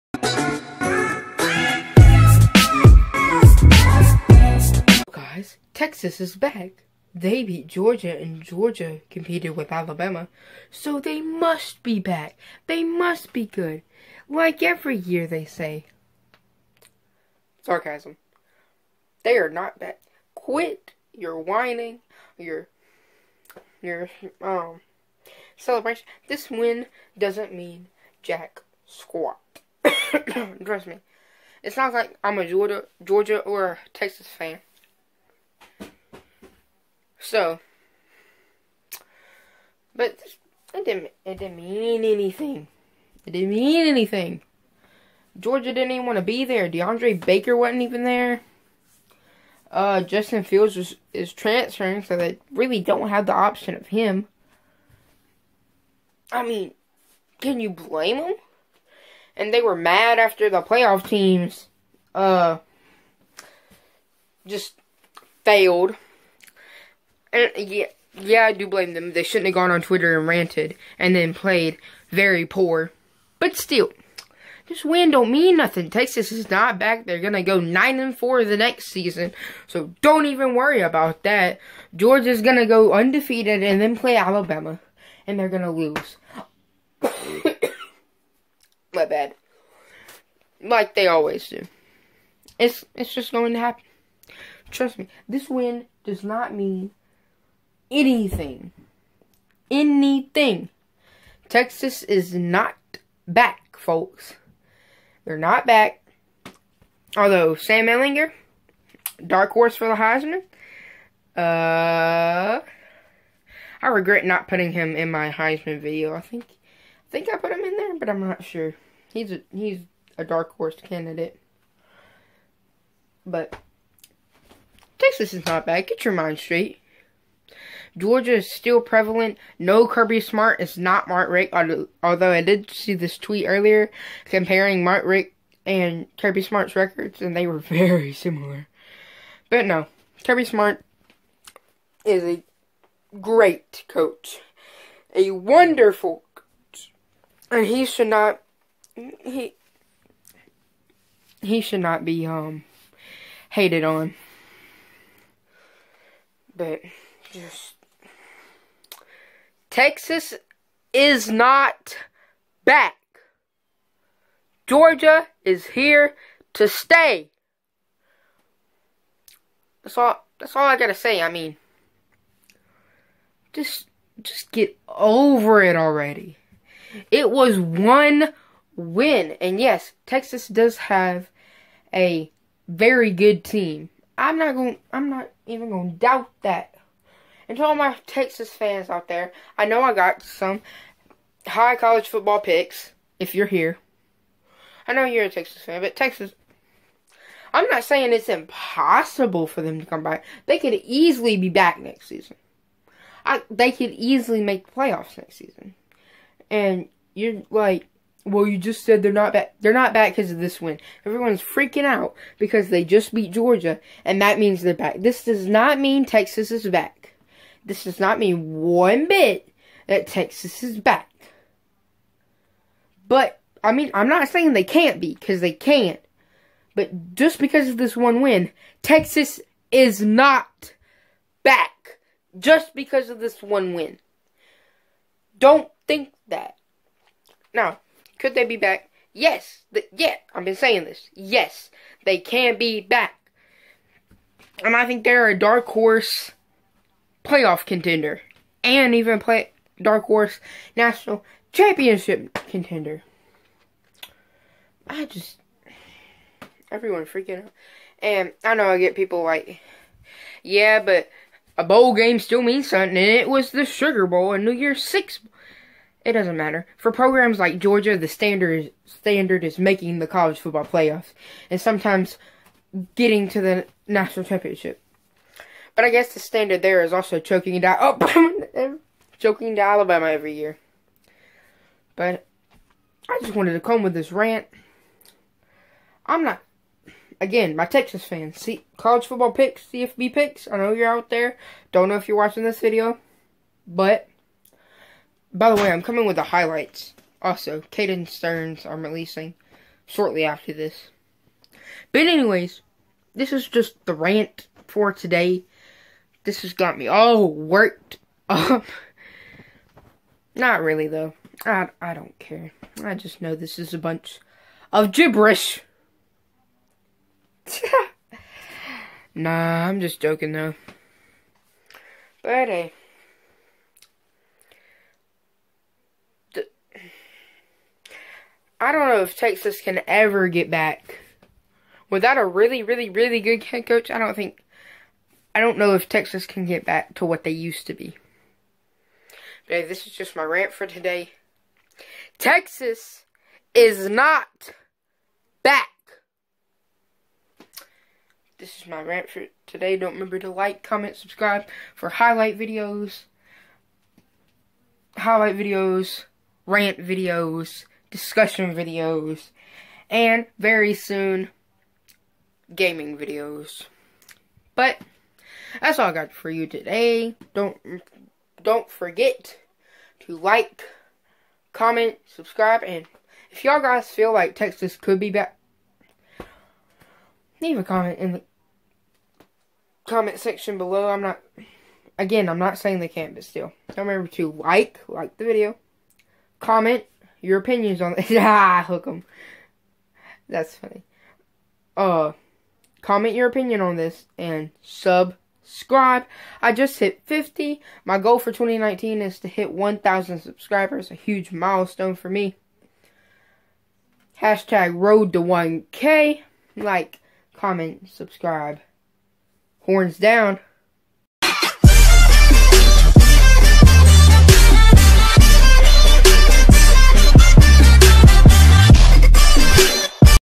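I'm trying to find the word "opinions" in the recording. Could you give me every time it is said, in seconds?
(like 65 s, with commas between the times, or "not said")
387 s, 393 s.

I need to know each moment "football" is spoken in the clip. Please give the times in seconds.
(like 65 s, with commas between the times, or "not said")
192 s, 270 s, 289 s.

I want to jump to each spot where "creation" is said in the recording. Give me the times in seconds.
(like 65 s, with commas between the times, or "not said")
not said.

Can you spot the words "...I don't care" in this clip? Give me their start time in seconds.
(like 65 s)
311 s.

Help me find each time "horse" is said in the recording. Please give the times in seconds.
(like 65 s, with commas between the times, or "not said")
109 s, 120 s, 245 s, 250 s.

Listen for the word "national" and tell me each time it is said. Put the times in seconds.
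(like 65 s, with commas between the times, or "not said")
250 s, 273 s.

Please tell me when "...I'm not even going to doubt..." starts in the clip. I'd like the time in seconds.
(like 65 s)
184 s.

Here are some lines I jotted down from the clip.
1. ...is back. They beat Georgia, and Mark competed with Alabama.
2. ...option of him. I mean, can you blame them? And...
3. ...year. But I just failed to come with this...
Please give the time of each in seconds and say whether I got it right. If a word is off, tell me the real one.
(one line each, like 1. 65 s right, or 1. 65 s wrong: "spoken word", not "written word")
1. 6 s wrong: "Georgia", not "Mark"
2. 53 s right
3. 280 s wrong: "wanted", not "failed".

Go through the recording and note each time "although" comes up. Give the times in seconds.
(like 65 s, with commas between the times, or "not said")
107 s, 131 s.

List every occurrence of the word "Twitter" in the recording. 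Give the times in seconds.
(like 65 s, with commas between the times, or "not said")
69 s.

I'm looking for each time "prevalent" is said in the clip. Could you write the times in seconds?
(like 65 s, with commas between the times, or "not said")
128 s.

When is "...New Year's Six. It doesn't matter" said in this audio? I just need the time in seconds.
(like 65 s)
264 s.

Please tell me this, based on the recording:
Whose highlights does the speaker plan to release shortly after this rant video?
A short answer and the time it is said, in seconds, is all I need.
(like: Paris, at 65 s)
Caden Sterns, at 297 s.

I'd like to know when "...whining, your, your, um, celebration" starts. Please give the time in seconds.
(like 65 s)
21 s.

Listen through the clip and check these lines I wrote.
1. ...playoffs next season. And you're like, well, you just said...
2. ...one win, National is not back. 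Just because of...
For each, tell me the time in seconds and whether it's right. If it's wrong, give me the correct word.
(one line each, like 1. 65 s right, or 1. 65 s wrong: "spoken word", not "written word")
1. 204 s right
2. 227 s wrong: "Texas", not "National".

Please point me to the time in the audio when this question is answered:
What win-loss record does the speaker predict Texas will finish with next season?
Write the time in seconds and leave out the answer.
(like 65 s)
77 s.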